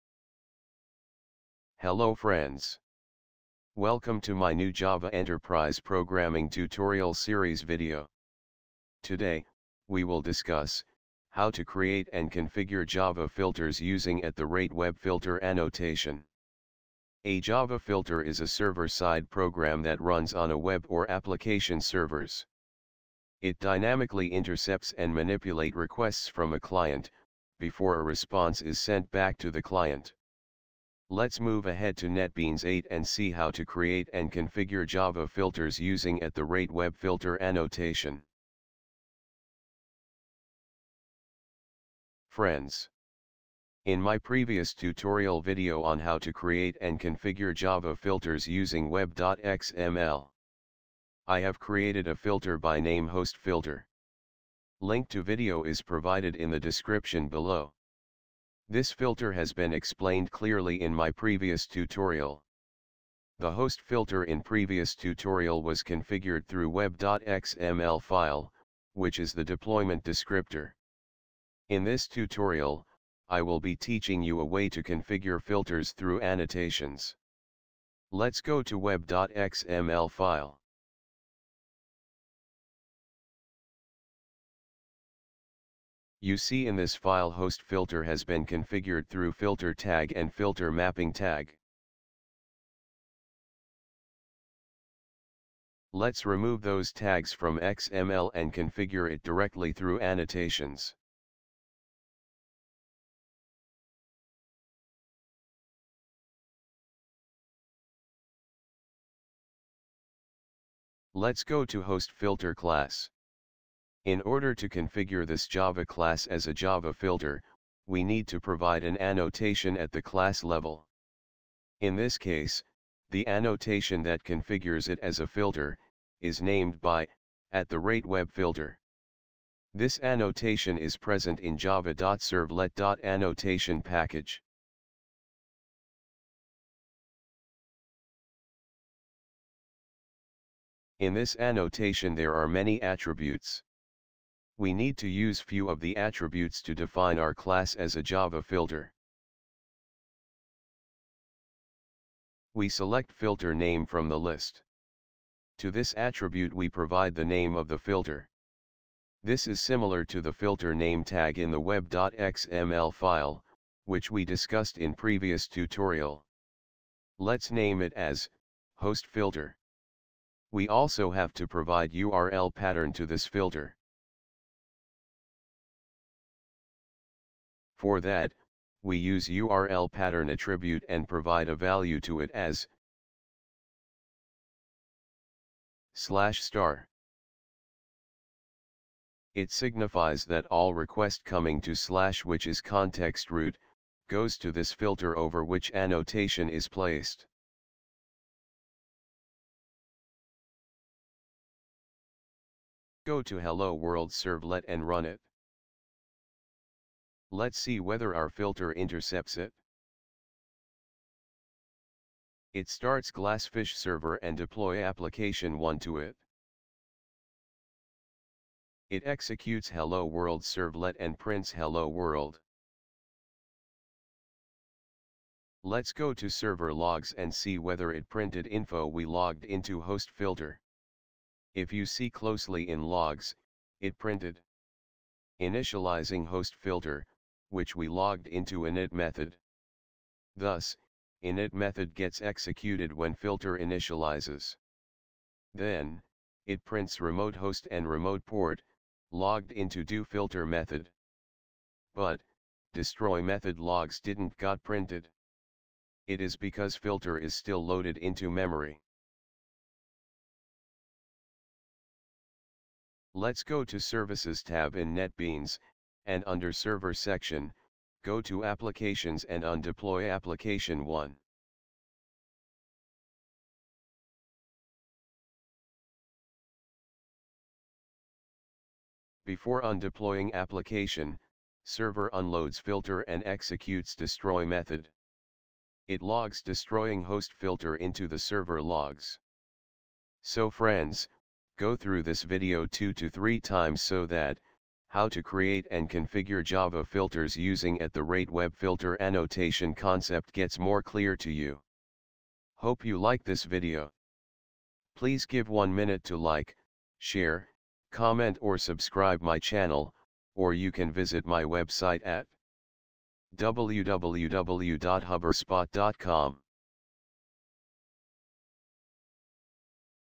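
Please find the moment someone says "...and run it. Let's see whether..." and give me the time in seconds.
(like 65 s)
204 s.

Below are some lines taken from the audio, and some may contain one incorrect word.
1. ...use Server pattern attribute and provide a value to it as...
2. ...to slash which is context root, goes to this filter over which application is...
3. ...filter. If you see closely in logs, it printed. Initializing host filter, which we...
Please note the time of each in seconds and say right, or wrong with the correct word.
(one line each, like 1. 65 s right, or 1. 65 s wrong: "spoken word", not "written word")
1. 178 s wrong: "URL", not "Server"
2. 191 s wrong: "annotation", not "application"
3. 230 s right.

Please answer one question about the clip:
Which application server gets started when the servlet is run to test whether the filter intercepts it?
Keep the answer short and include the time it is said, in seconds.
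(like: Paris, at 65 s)
Glassfish, at 213 s.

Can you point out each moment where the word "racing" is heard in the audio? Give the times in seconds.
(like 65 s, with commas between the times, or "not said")
not said.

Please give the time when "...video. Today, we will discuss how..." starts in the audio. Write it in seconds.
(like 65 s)
7 s.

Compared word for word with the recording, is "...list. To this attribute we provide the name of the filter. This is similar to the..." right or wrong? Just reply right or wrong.
right.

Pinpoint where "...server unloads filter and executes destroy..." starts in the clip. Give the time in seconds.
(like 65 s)
281 s.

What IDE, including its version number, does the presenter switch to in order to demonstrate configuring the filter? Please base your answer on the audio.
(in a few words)
NetBeans 8.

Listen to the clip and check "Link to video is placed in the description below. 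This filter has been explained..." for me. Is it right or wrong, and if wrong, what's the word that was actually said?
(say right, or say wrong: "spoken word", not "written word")
wrong: "provided", not "placed".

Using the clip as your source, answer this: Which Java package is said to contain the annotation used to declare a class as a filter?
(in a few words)
java.servlet.annotation.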